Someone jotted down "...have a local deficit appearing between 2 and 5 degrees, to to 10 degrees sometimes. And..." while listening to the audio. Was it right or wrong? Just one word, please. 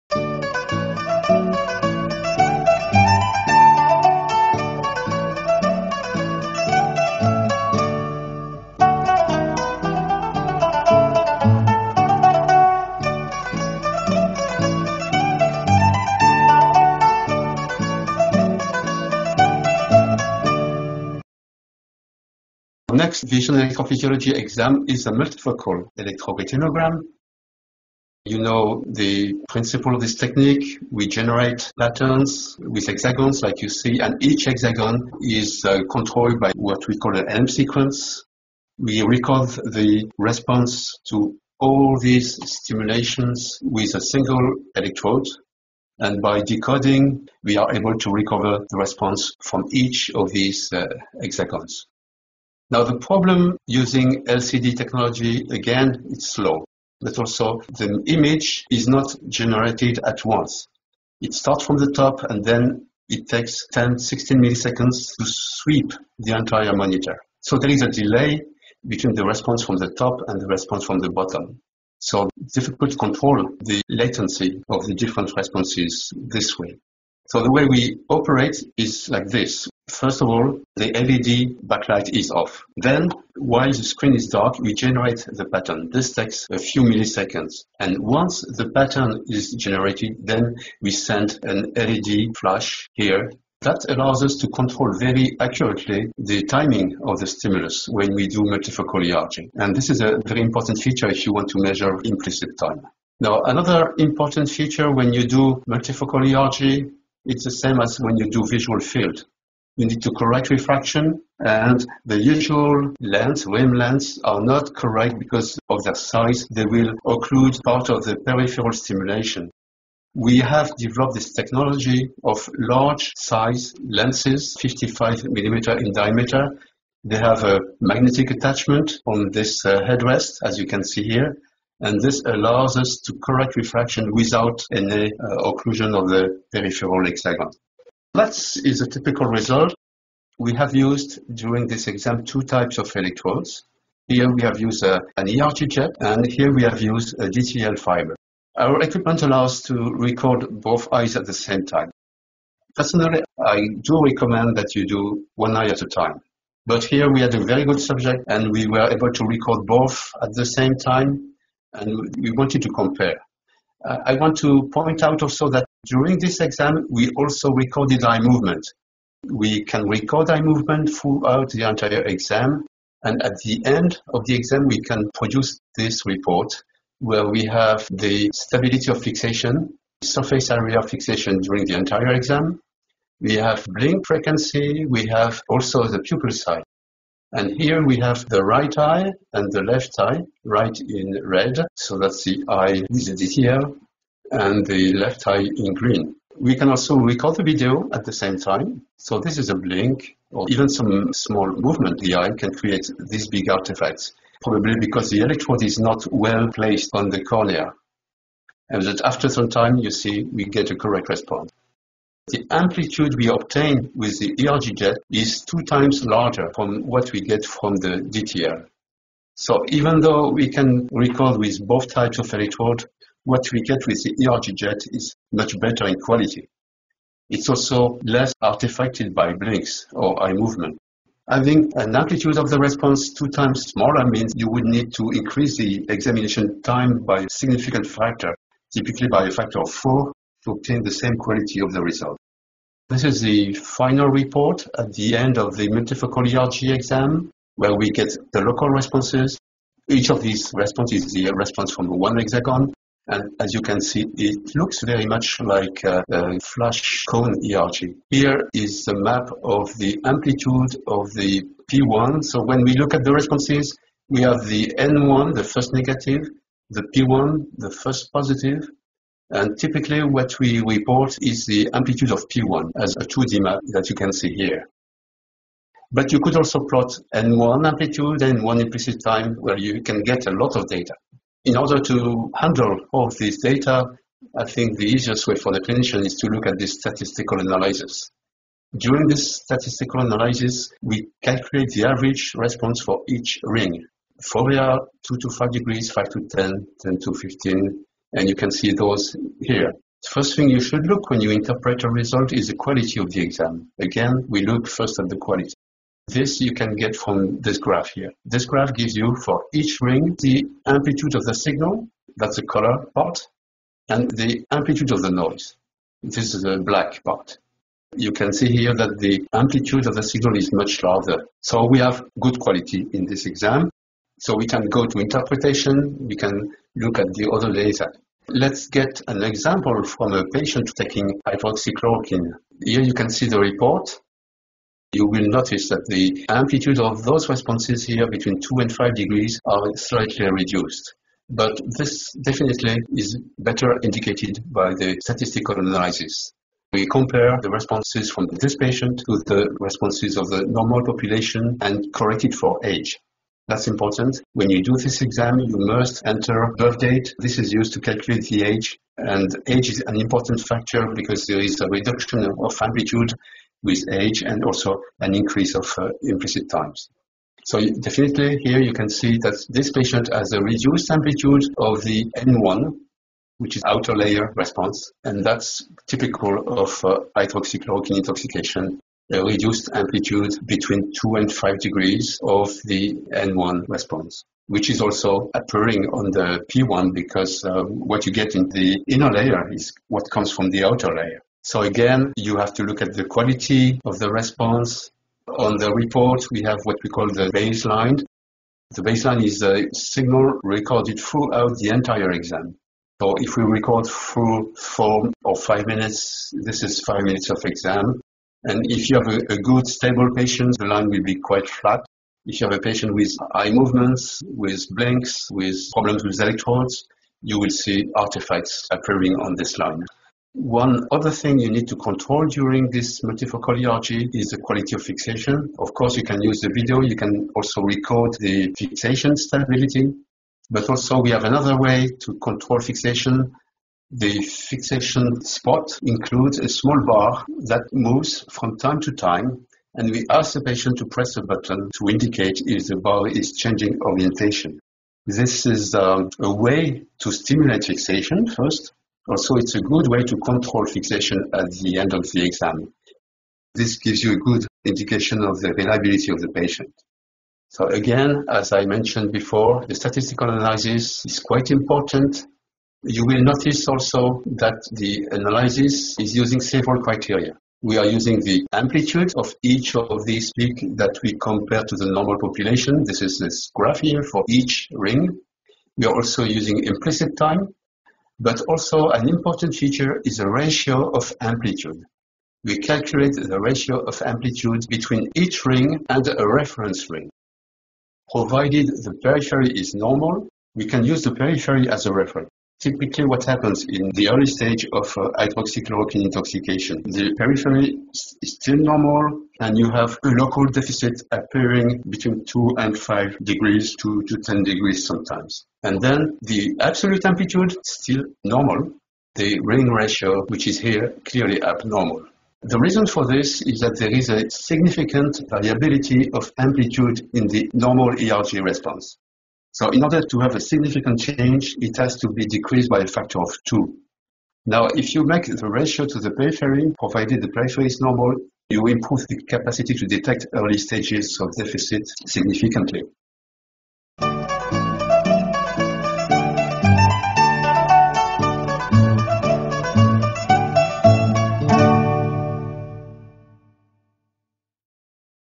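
right.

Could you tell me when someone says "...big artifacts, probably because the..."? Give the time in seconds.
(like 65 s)
203 s.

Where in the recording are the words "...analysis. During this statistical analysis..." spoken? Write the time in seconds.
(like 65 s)
287 s.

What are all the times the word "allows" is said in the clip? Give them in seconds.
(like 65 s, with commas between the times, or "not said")
93 s, 132 s, 149 s.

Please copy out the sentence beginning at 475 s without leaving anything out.
We are also using implicit time, but also an important feature is the ratio of amplitude.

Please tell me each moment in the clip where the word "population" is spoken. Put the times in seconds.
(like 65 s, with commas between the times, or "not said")
350 s, 472 s.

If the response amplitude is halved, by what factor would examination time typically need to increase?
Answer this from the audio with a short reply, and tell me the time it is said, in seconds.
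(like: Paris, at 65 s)
4, at 239 s.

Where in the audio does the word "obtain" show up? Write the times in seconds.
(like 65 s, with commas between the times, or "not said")
213 s, 240 s.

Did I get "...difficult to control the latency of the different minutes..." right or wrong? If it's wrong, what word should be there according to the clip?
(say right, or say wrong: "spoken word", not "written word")
wrong: "responses", not "minutes".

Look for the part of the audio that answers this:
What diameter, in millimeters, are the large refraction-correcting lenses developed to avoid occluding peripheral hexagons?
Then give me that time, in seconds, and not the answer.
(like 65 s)
124 s.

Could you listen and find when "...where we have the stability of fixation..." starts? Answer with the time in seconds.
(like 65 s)
176 s.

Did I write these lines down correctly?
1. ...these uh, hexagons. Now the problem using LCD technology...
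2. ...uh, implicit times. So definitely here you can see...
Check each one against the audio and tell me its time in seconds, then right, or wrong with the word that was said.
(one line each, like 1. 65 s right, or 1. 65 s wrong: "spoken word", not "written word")
1. 50 s right
2. 365 s right.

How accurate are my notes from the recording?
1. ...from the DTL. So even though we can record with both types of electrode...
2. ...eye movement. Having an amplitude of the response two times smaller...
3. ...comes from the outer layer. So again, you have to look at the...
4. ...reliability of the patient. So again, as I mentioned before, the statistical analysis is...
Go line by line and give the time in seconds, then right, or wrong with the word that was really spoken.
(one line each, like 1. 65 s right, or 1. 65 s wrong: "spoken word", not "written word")
1. 217 s right
2. 230 s right
3. 390 s right
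4. 455 s right.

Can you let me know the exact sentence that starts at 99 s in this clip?
And this is a very important feature if you want to measure implicit time.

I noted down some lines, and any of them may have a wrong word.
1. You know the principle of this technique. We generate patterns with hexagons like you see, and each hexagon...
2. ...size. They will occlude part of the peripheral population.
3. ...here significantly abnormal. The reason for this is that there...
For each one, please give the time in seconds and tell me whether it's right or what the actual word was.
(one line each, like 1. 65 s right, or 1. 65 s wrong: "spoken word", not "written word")
1. 28 s right
2. 115 s wrong: "stimulation", not "population"
3. 510 s wrong: "clearly", not "significantly".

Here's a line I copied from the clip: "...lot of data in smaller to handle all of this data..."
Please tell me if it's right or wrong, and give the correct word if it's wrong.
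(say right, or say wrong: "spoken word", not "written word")
wrong: "order", not "smaller".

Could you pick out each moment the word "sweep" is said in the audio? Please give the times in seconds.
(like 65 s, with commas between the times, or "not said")
65 s.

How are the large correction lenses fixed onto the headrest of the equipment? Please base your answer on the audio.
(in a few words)
Magnetic attachment.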